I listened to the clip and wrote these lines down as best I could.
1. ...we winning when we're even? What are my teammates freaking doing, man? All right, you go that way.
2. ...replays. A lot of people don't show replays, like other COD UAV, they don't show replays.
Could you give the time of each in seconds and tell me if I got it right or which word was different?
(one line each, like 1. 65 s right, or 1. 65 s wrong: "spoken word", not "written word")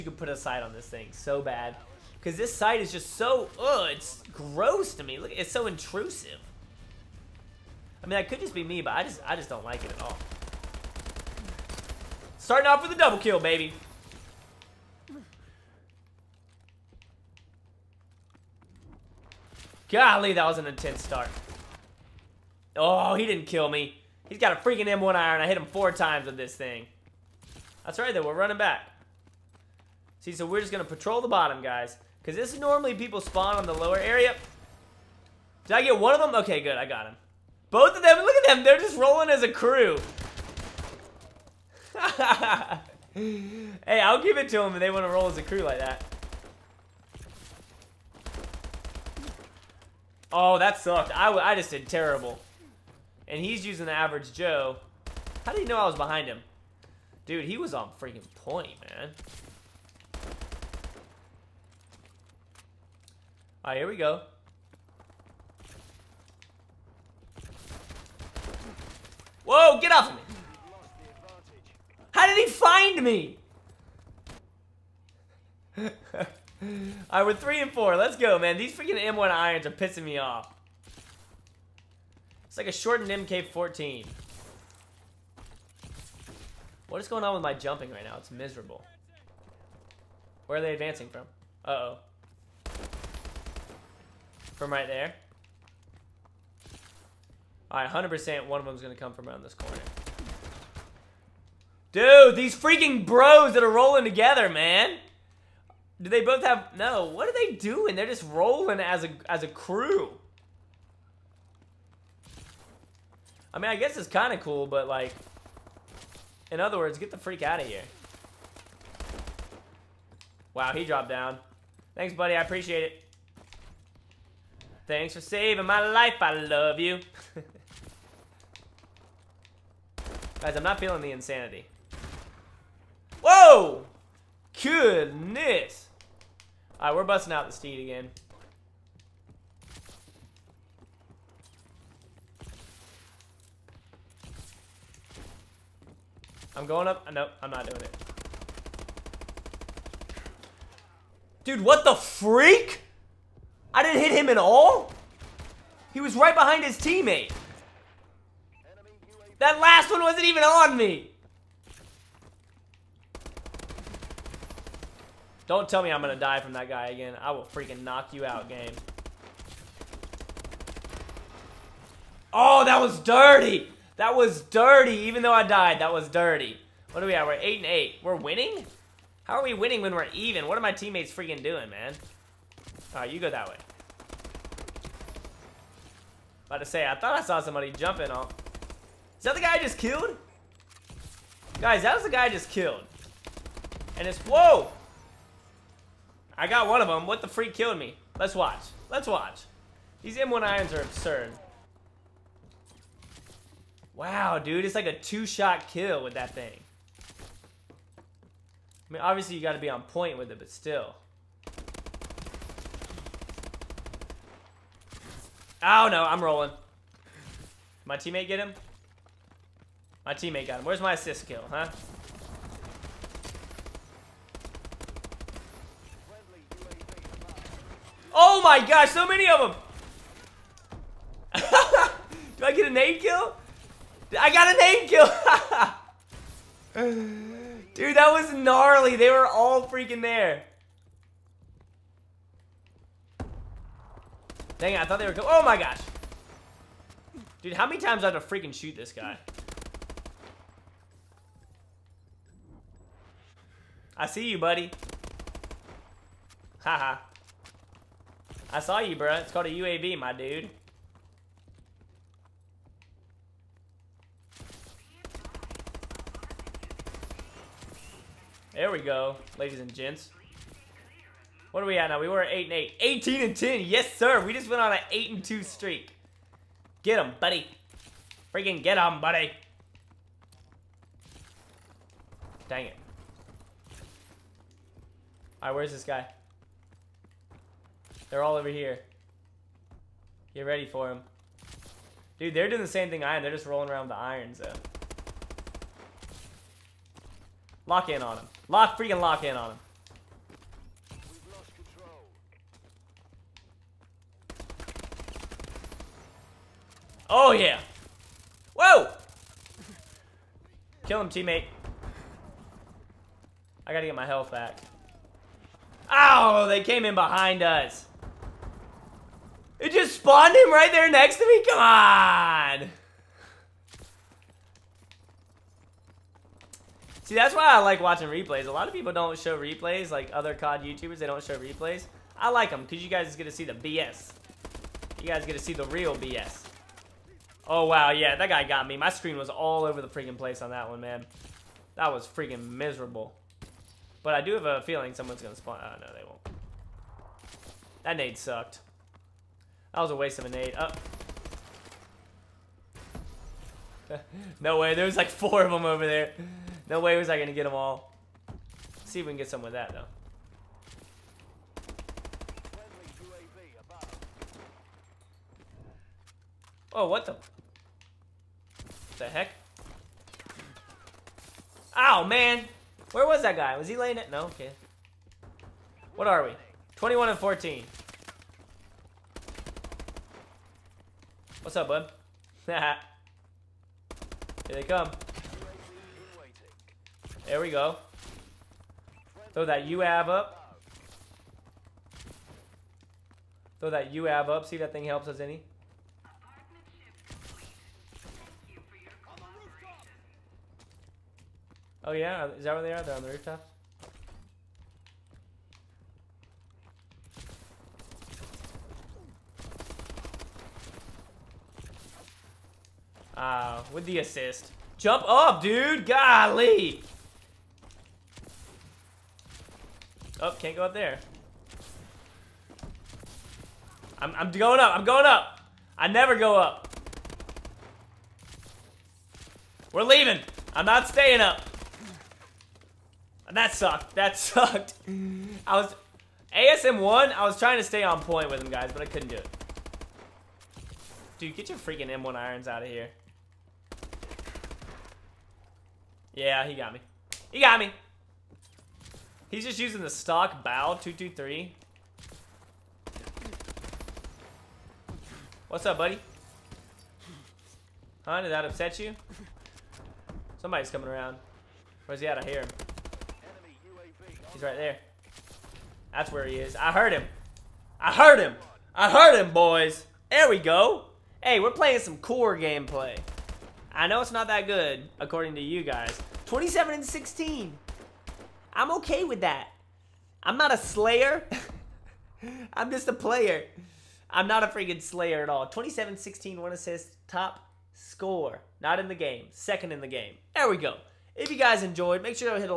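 1. 179 s right
2. 328 s wrong: "YouTubers", not "UAV".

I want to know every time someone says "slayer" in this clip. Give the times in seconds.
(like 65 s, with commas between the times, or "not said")
480 s, 484 s.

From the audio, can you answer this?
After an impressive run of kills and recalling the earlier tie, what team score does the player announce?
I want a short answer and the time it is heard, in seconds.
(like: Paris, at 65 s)
18 and 10, at 272 s.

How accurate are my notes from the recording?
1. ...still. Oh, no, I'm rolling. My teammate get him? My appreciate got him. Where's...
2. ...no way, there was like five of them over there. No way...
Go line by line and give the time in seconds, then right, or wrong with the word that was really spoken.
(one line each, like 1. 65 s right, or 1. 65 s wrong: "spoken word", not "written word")
1. 210 s wrong: "teammate", not "appreciate"
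2. 354 s wrong: "four", not "five".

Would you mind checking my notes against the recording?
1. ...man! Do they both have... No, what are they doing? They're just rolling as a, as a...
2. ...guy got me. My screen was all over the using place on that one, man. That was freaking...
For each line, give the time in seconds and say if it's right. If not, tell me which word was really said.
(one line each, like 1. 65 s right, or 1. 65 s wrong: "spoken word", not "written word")
1. 104 s right
2. 338 s wrong: "freaking", not "using".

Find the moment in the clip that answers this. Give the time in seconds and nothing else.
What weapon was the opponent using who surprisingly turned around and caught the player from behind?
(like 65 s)
53 s.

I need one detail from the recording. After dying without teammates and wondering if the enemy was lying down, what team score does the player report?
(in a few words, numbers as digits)
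21 and 14.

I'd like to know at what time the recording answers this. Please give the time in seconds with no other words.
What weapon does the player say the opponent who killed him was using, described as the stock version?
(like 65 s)
450 s.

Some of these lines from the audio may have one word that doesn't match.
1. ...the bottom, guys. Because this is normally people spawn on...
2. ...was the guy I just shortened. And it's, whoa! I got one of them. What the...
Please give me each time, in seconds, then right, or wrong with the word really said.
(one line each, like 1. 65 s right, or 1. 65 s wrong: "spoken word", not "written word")
1. 31 s right
2. 191 s wrong: "killed", not "shortened".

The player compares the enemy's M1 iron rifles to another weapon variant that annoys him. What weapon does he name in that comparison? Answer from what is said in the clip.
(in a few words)
Shortened MK-14.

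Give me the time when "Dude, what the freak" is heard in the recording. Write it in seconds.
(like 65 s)
151 s.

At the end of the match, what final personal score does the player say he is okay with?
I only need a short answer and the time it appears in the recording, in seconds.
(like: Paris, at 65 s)
27 and 16, at 476 s.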